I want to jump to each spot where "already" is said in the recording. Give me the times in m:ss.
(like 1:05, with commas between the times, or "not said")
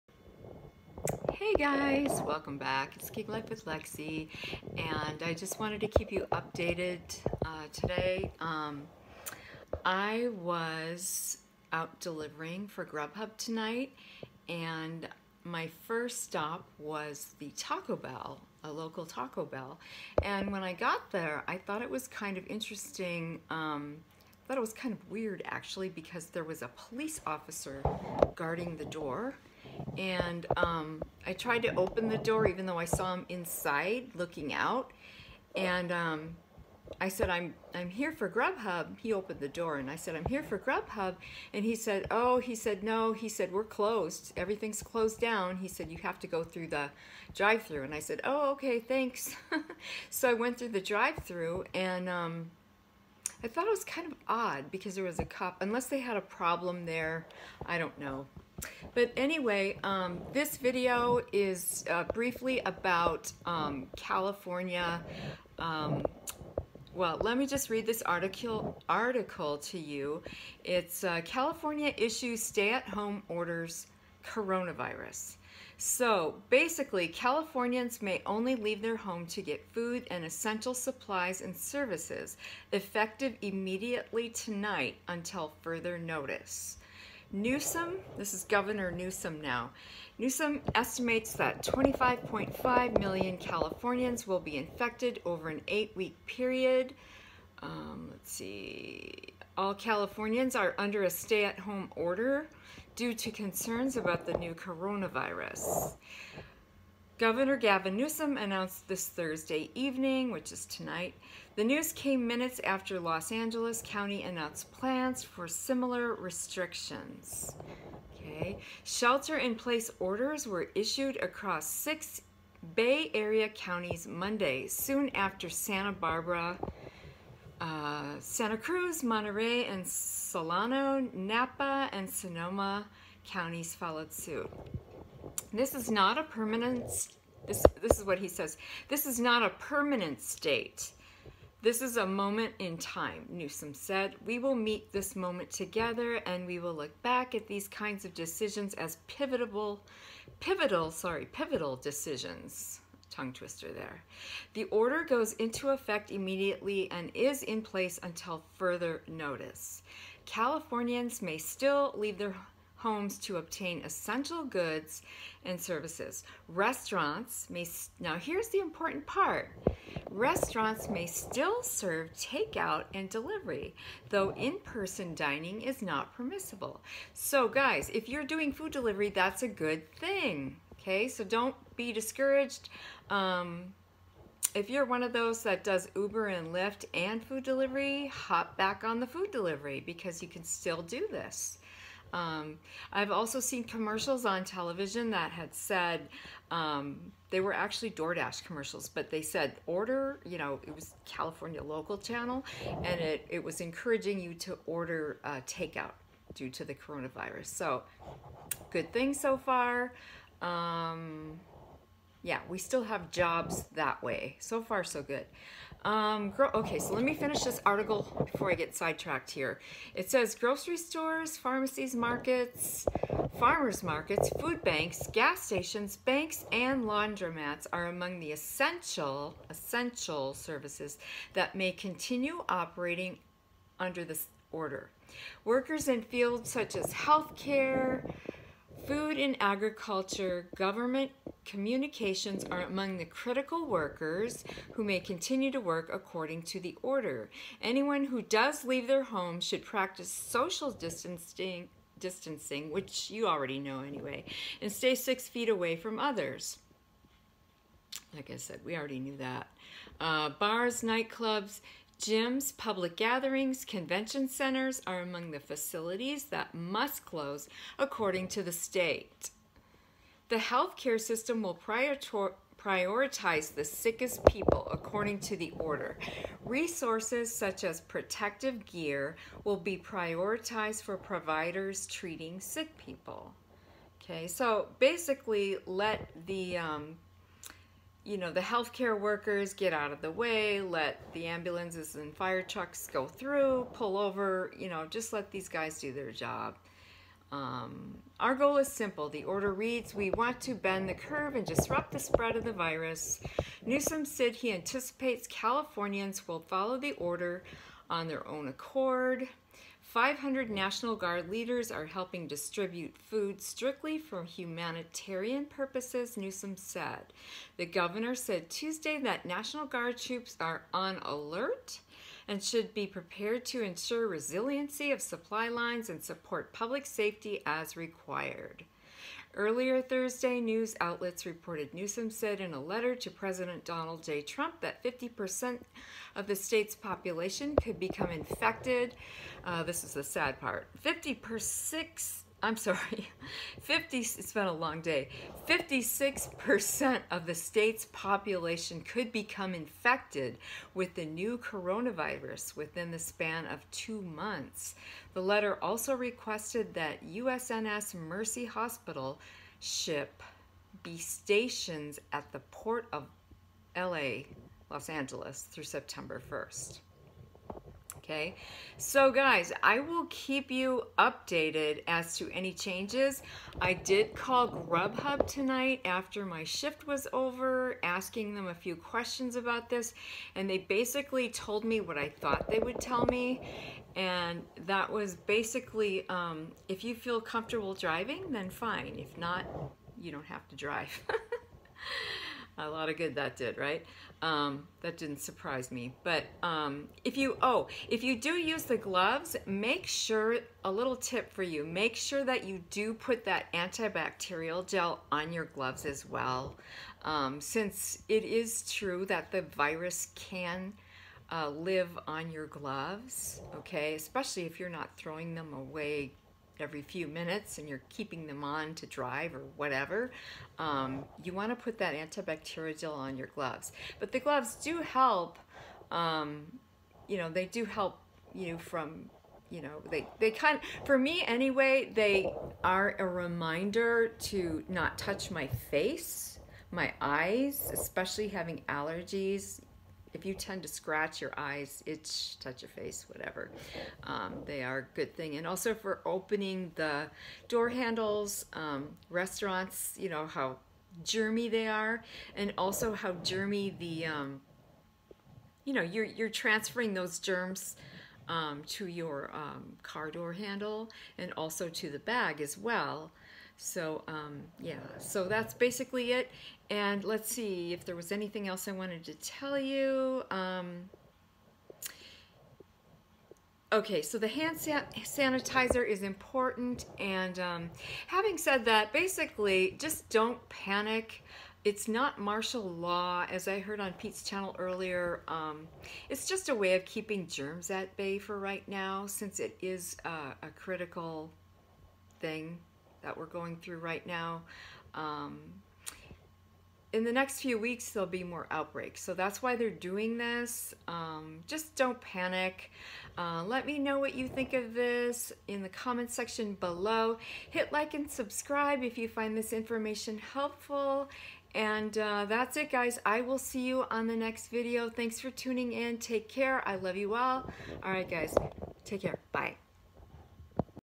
4:13, 4:18.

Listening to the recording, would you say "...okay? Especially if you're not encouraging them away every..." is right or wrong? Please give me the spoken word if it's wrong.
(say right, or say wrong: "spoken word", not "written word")
wrong: "throwing", not "encouraging".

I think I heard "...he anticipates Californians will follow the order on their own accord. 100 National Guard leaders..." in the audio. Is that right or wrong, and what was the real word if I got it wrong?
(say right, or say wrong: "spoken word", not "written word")
wrong: "500", not "100".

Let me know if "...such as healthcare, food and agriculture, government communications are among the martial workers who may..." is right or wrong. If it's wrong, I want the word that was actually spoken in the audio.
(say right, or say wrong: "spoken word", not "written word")
wrong: "critical", not "martial".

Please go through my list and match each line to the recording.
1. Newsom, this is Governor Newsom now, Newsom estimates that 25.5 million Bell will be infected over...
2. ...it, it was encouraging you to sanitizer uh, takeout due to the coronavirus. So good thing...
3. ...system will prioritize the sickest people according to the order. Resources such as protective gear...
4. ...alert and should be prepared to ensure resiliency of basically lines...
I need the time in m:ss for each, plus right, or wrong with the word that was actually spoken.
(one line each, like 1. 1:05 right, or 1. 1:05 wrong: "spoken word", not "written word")
1. 1:27 wrong: "Californians", not "Bell"
2. 3:22 wrong: "order", not "sanitizer"
3. 4:30 right
4. 5:21 wrong: "supply", not "basically".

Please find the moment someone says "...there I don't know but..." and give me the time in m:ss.
0:56.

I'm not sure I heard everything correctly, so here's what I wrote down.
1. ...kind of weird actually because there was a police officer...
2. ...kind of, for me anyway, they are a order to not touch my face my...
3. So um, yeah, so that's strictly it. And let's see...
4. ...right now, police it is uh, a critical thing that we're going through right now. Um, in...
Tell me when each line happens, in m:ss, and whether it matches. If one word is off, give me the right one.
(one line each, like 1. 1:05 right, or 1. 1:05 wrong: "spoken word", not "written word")
1. 0:24 right
2. 7:10 wrong: "reminder", not "order"
3. 7:43 wrong: "basically", not "strictly"
4. 8:08 wrong: "since", not "police".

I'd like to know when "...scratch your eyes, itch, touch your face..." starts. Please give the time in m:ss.
7:20.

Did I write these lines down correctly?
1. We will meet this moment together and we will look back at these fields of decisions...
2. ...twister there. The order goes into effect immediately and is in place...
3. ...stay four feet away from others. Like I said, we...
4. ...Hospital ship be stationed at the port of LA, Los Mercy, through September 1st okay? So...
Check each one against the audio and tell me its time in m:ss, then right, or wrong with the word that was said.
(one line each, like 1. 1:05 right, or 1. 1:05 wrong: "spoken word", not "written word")
1. 2:24 wrong: "kinds", not "fields"
2. 2:33 right
3. 4:14 wrong: "six", not "four"
4. 5:58 wrong: "Angeles", not "Mercy".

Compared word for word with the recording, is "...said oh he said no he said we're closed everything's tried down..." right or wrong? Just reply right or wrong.
wrong.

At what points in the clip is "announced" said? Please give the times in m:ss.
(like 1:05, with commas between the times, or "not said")
1:48, 1:54.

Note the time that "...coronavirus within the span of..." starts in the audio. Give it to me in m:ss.
5:51.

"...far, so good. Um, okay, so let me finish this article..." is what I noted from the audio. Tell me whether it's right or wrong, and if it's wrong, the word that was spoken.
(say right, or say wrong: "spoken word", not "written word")
right.